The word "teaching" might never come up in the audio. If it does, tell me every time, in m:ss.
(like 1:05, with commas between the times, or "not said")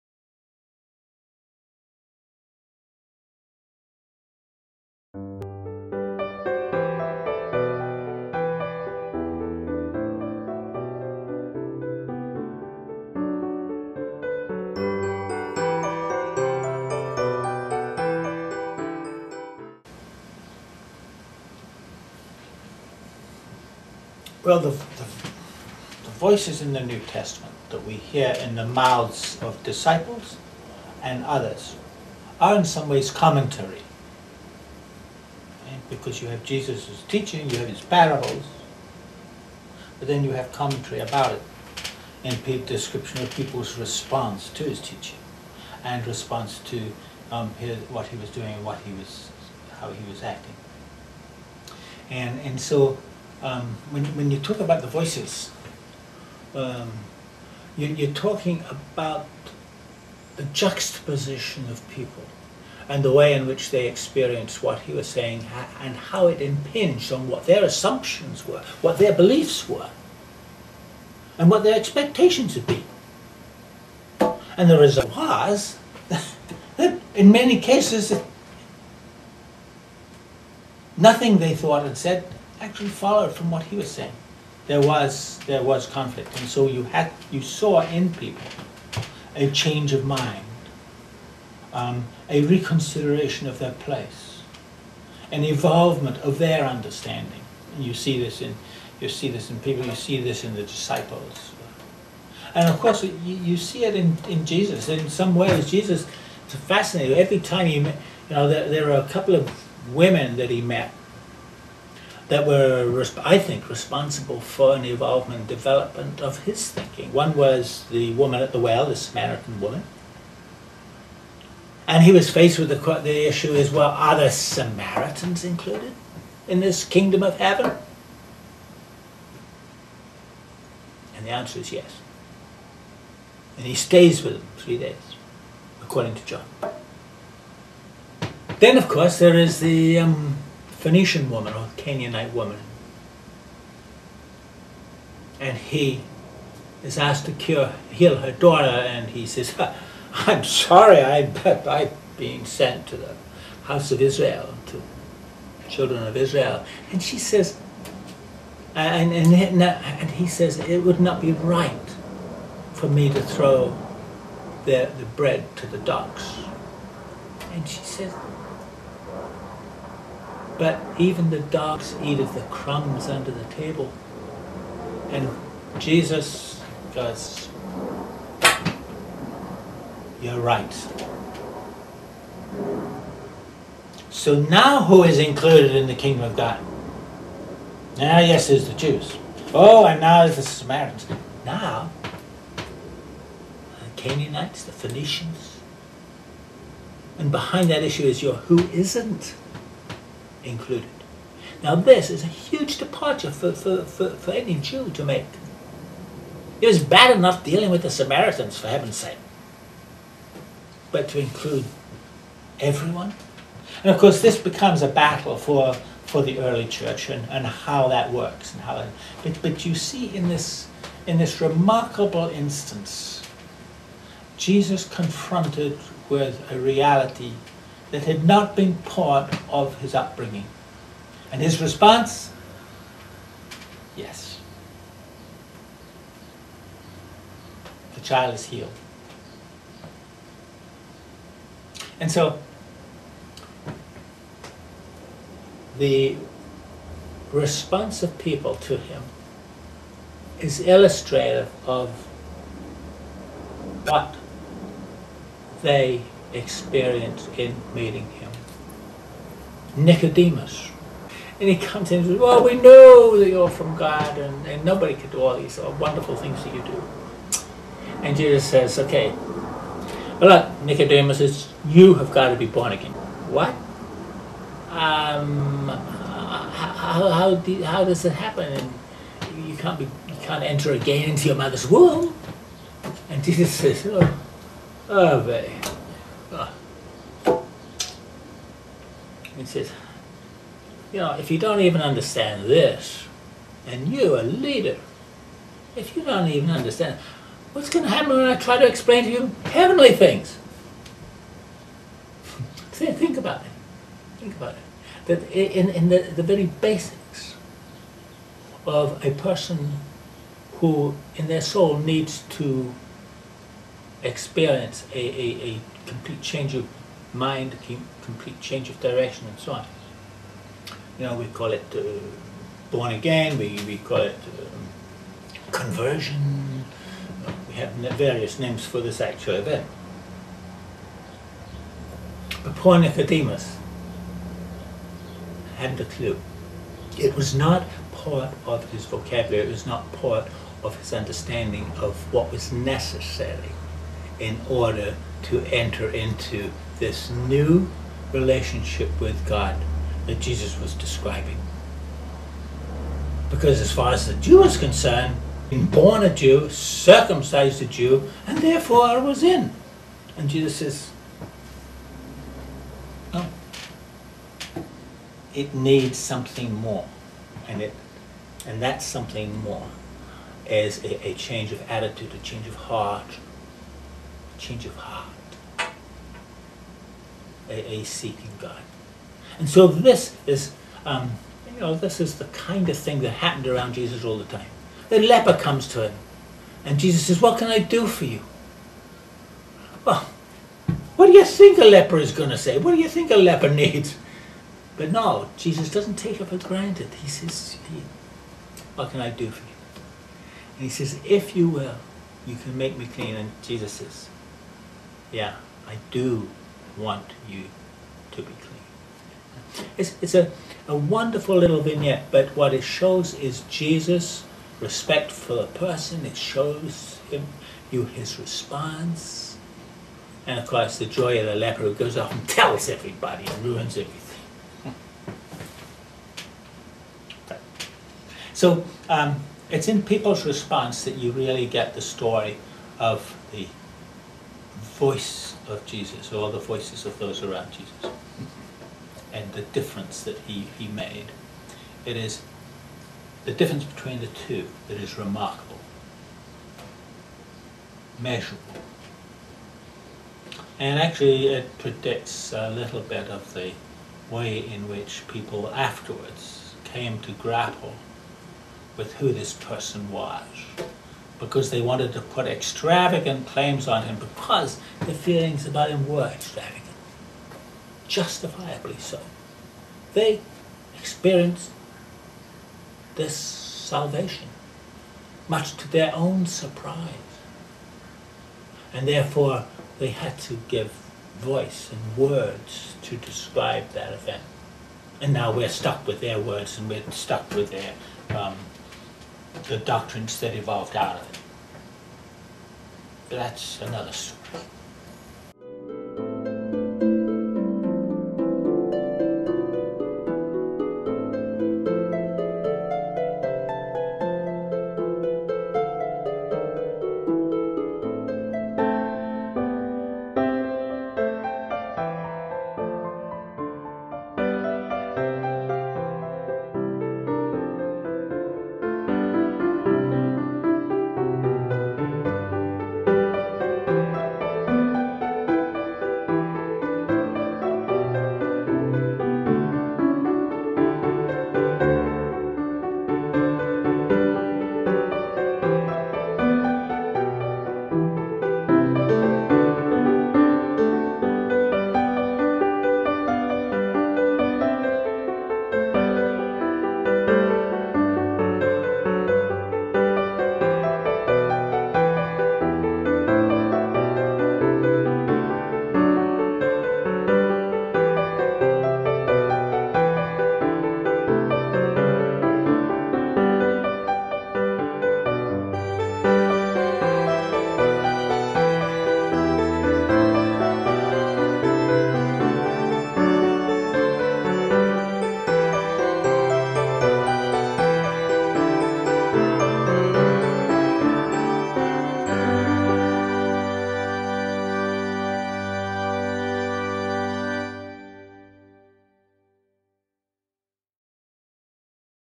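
0:37, 0:44.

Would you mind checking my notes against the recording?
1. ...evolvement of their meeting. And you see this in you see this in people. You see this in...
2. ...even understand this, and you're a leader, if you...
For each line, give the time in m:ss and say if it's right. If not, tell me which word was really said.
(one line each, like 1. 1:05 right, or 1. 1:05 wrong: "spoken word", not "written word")
1. 1:35 wrong: "understanding", not "meeting"
2. 4:51 right.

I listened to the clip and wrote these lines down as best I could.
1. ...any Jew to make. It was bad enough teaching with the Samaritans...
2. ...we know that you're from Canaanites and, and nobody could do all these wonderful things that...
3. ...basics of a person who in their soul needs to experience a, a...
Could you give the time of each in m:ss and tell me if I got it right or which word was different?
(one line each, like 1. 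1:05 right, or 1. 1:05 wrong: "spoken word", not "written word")
1. 3:24 wrong: "dealing", not "teaching"
2. 4:22 wrong: "God", not "Canaanites"
3. 5:06 right.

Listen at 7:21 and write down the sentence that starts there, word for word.
It is the difference between the two that is remarkable, measurable.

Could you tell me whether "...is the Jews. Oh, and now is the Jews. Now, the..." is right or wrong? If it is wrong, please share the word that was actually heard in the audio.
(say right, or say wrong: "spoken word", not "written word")
wrong: "Samaritans", not "Jews".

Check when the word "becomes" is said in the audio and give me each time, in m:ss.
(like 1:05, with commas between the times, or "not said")
3:34.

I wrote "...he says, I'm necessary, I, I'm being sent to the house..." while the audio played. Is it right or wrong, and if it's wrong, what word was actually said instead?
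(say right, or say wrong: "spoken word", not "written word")
wrong: "sorry", not "necessary".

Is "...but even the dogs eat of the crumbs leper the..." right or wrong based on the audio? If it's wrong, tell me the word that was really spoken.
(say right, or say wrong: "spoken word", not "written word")
wrong: "under", not "leper".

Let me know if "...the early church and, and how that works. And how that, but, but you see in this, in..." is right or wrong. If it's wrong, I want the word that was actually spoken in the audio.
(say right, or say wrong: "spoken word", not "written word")
right.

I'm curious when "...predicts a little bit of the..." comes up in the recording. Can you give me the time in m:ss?
7:31.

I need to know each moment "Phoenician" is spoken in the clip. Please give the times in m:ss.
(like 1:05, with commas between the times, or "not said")
2:20, 3:14.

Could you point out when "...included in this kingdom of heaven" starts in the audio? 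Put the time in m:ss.
2:05.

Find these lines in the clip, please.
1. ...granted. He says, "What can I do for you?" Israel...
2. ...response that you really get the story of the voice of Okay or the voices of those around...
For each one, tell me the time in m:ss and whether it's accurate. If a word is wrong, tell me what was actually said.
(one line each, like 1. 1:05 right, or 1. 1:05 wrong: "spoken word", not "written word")
1. 6:36 wrong: "And", not "Israel"
2. 7:10 wrong: "Jesus", not "Okay".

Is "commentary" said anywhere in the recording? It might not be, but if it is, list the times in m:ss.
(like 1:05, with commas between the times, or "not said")
0:33, 0:40.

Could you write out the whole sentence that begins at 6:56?
It shows him you his response.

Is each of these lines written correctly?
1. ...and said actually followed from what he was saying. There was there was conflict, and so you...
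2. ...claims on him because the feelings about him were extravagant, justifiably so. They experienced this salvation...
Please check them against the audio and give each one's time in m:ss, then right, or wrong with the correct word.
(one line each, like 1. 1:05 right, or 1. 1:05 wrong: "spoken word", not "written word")
1. 1:21 right
2. 7:43 right.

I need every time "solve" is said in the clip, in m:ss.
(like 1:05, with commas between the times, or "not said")
not said.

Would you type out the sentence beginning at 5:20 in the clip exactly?
You know, we call it uh, born again, we, we call it um, conversion.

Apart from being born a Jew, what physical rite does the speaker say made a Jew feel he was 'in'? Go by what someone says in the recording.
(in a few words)
circumcised.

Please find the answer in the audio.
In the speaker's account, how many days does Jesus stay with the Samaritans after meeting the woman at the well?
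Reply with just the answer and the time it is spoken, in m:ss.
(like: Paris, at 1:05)
3, at 2:14.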